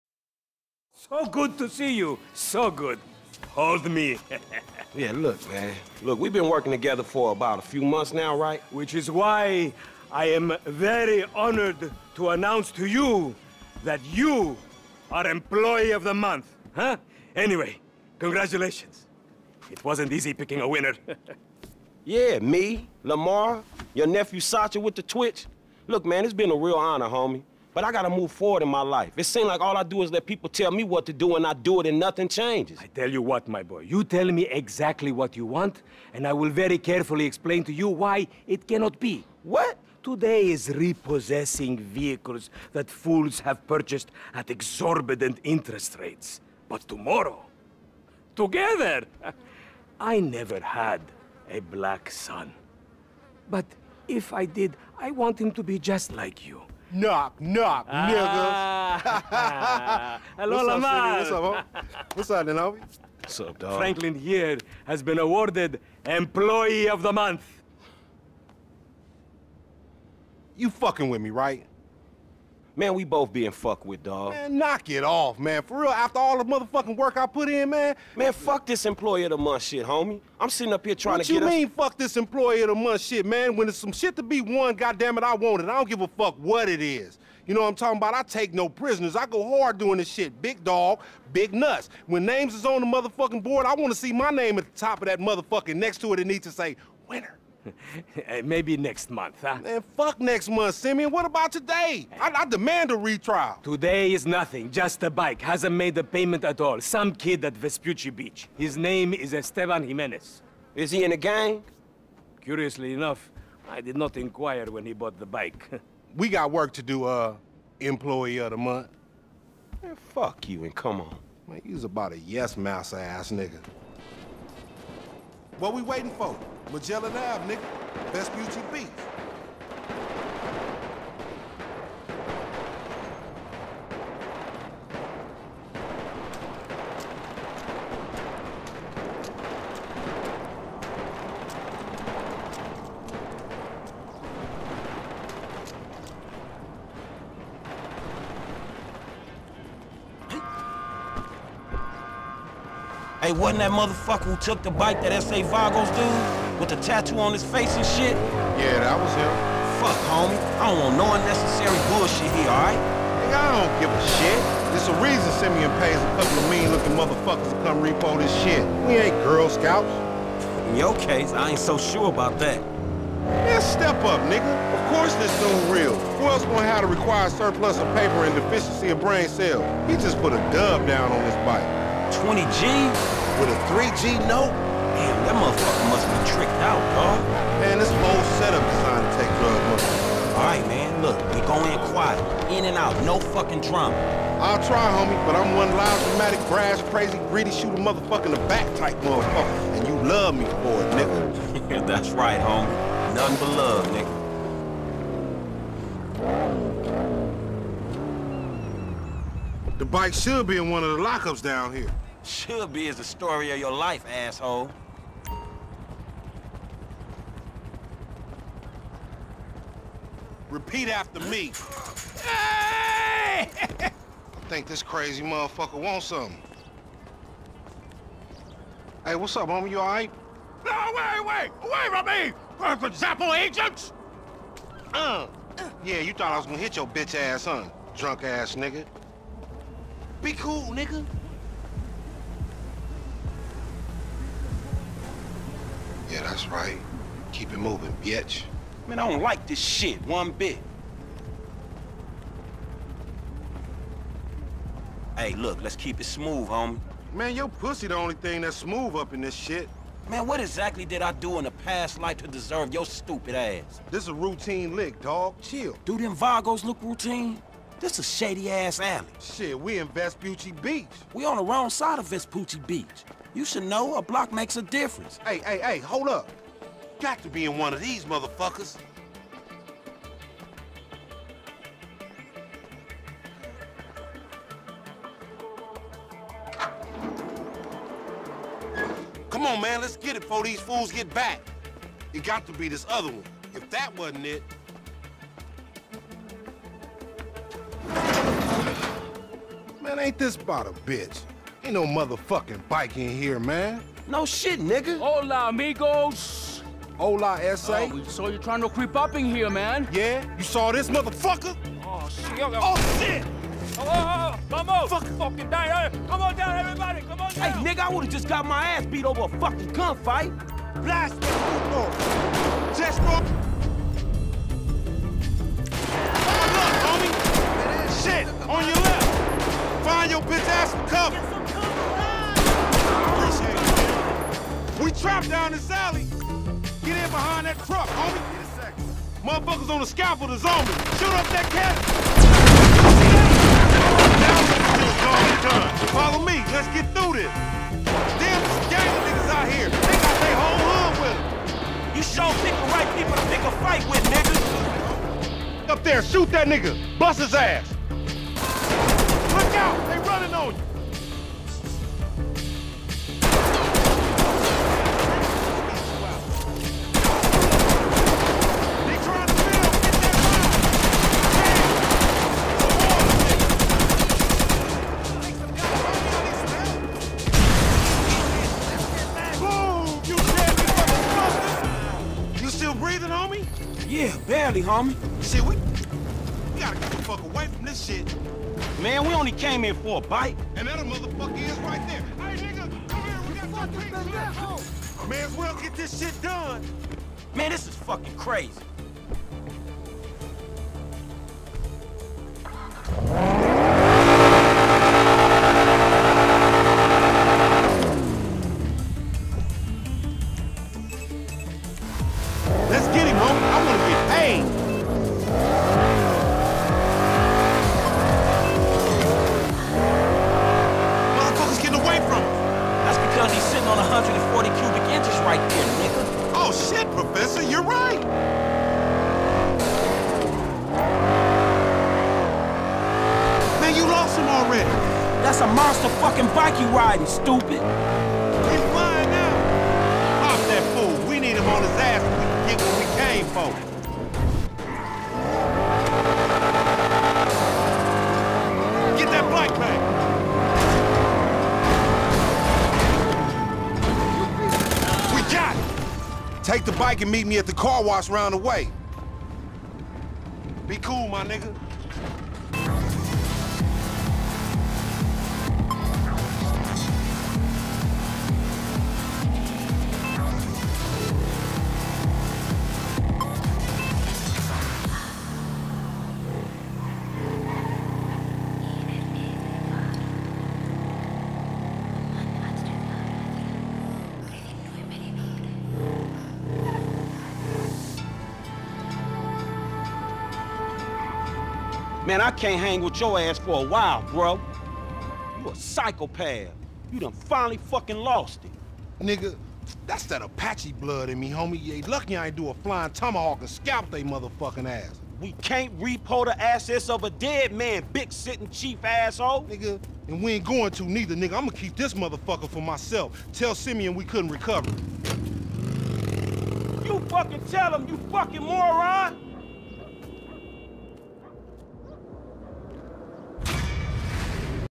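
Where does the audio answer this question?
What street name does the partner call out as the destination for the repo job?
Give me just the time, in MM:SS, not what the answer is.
02:06.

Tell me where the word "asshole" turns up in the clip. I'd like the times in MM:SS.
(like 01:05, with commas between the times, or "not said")
03:34, 08:28.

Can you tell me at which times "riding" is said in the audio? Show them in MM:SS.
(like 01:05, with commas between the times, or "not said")
07:16.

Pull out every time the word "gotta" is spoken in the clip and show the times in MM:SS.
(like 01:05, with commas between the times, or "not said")
00:27, 06:26.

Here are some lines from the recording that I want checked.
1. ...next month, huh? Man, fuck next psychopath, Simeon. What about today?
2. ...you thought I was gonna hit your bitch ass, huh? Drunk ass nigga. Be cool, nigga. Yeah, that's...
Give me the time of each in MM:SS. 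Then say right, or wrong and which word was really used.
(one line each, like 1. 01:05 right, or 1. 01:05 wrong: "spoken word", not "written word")
1. 01:38 wrong: "month", not "psychopath"
2. 03:56 right.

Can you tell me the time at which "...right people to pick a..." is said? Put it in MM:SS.
05:52.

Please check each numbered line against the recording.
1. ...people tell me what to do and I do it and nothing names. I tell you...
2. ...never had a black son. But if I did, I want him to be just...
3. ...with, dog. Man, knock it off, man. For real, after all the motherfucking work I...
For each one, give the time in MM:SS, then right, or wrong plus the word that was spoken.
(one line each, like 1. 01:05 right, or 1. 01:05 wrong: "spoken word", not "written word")
1. 00:30 wrong: "changes", not "names"
2. 00:50 right
3. 01:13 right.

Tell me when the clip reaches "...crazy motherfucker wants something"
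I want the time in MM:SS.
03:44.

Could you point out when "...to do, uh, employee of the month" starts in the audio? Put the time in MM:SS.
01:56.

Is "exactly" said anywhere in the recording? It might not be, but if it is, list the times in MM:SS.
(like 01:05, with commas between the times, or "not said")
00:34, 04:20.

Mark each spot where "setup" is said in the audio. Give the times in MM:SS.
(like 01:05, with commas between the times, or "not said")
03:08.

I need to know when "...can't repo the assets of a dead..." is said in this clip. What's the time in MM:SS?
08:25.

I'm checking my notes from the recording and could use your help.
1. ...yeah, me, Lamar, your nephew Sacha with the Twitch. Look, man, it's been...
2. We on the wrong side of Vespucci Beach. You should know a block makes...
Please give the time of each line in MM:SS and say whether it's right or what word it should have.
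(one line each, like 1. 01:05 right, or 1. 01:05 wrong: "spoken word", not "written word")
1. 00:22 right
2. 04:31 right.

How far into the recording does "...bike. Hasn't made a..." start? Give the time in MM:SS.
01:45.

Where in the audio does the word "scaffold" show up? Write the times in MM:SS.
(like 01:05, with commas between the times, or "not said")
05:39.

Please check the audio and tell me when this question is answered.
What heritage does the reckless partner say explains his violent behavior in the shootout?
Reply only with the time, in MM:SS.
08:20.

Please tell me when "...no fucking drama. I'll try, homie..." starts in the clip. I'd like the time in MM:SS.
03:13.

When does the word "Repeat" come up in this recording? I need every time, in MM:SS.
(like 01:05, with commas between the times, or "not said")
03:40.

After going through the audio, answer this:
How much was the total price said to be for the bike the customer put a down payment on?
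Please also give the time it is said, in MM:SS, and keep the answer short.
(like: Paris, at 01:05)
20 G's, at 03:02.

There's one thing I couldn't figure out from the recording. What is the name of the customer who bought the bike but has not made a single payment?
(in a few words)
Esteban Jimenez.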